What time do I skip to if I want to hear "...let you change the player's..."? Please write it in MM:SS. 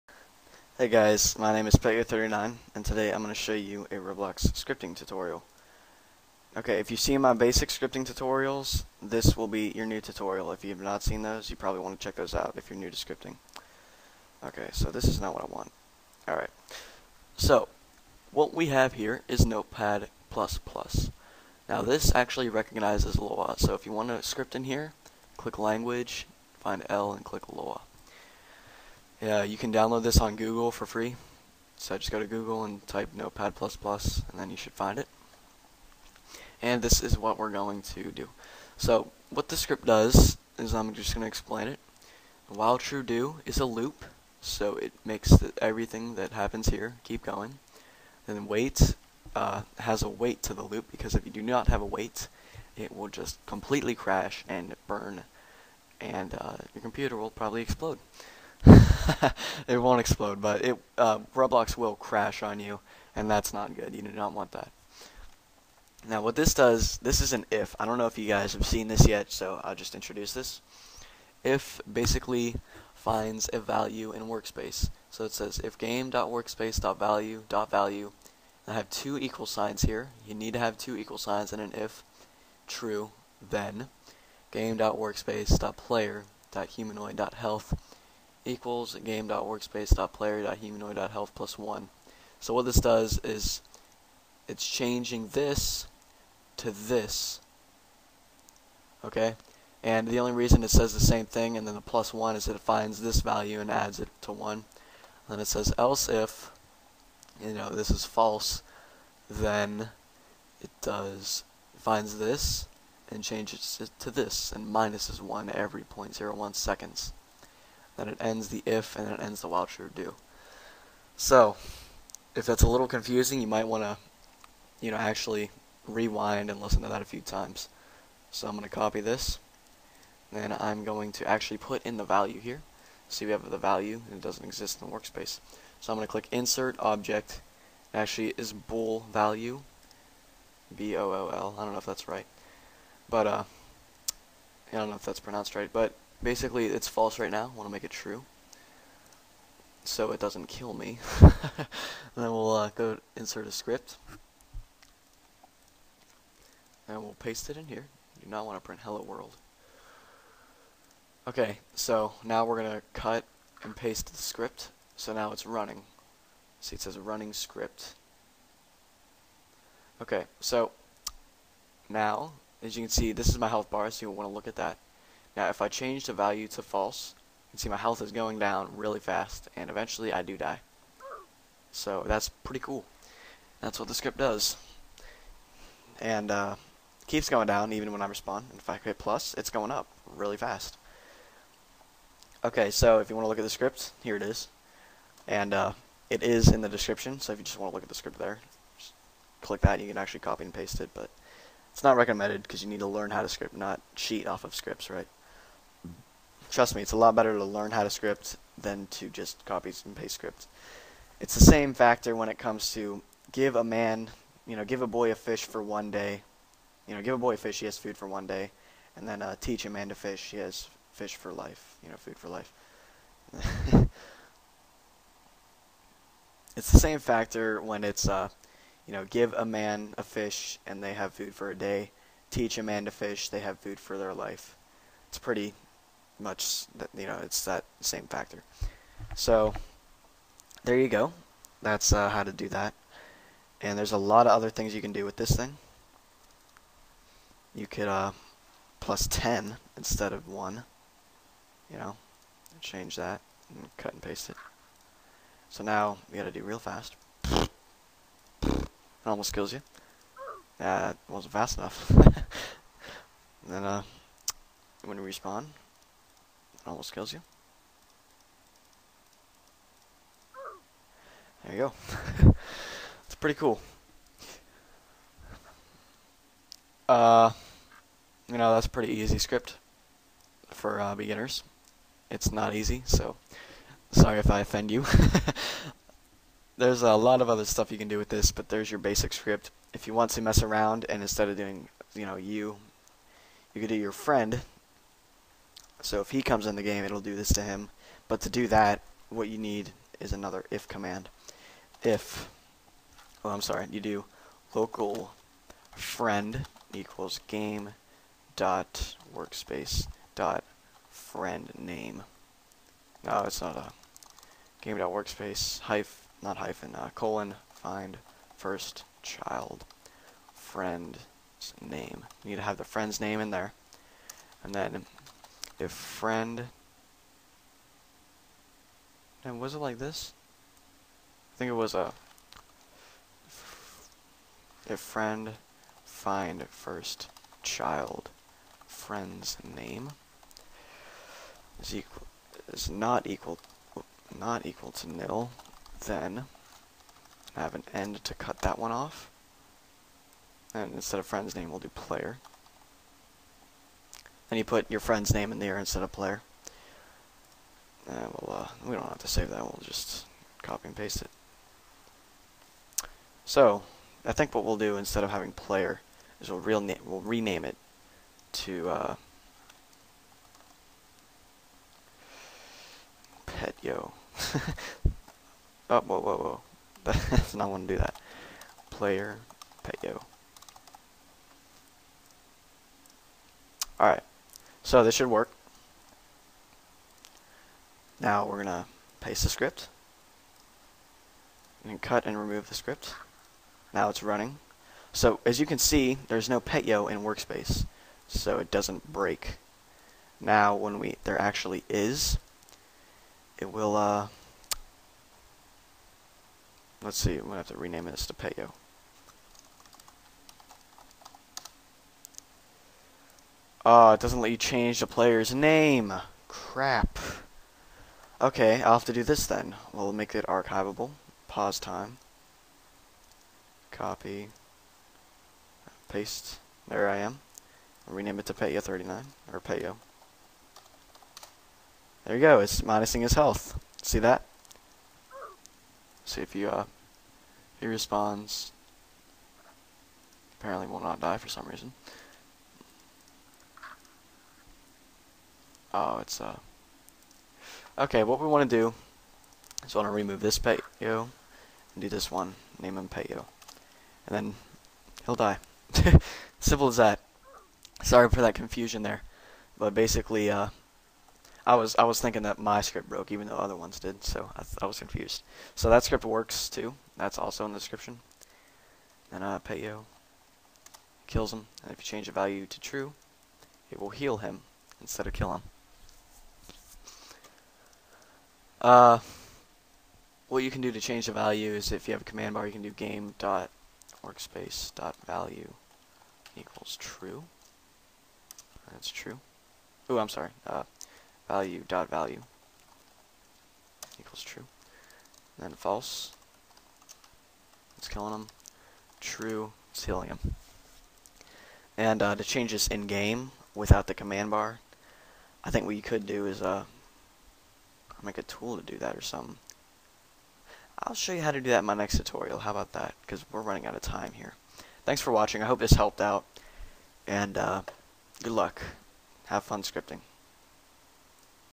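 06:54.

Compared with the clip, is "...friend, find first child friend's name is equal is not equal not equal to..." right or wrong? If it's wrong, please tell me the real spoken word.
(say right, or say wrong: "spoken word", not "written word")
right.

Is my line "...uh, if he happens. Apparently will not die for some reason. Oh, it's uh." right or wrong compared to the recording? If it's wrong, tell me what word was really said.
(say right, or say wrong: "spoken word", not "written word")
wrong: "respawns", not "happens".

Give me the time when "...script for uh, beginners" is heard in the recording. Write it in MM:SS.
04:39.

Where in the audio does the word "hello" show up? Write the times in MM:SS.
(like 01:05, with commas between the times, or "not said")
02:38.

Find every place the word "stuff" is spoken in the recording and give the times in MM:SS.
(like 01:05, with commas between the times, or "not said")
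04:47.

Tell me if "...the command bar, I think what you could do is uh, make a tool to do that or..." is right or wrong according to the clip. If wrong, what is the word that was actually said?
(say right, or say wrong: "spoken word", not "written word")
right.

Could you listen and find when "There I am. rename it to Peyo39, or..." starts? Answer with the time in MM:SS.
07:06.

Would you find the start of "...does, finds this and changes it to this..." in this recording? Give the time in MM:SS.
01:50.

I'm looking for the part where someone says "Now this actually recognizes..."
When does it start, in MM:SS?
00:21.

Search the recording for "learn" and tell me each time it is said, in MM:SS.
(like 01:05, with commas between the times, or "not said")
03:22, 03:27.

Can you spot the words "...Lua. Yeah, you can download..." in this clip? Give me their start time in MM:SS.
00:27.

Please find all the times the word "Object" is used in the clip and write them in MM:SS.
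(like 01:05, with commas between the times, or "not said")
02:16.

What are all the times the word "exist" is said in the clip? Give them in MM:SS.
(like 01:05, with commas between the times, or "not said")
02:14.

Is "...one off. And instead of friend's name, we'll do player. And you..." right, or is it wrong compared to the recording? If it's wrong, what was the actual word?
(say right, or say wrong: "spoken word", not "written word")
right.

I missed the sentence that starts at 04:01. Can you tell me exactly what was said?
That's uh, how to do that.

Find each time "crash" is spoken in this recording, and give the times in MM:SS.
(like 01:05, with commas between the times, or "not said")
00:53, 01:01.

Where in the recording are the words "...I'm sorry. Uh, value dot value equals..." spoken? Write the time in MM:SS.
08:09.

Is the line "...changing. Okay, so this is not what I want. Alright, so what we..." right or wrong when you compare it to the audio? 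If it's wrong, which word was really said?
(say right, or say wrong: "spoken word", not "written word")
wrong: "scripting", not "changing".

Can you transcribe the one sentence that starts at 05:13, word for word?
No, it's not a game dot workspace hyphen, not hyphen, uh, colon, find first child friend's name.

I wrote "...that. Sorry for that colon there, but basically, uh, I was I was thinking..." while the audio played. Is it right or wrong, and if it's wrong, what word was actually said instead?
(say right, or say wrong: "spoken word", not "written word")
wrong: "confusion", not "colon".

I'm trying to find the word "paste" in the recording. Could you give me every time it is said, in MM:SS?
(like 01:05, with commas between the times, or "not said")
02:37, 02:43, 03:20, 03:29, 04:14, 06:00, 06:28, 07:05.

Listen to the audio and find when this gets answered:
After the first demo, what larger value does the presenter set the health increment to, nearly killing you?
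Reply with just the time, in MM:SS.
04:08.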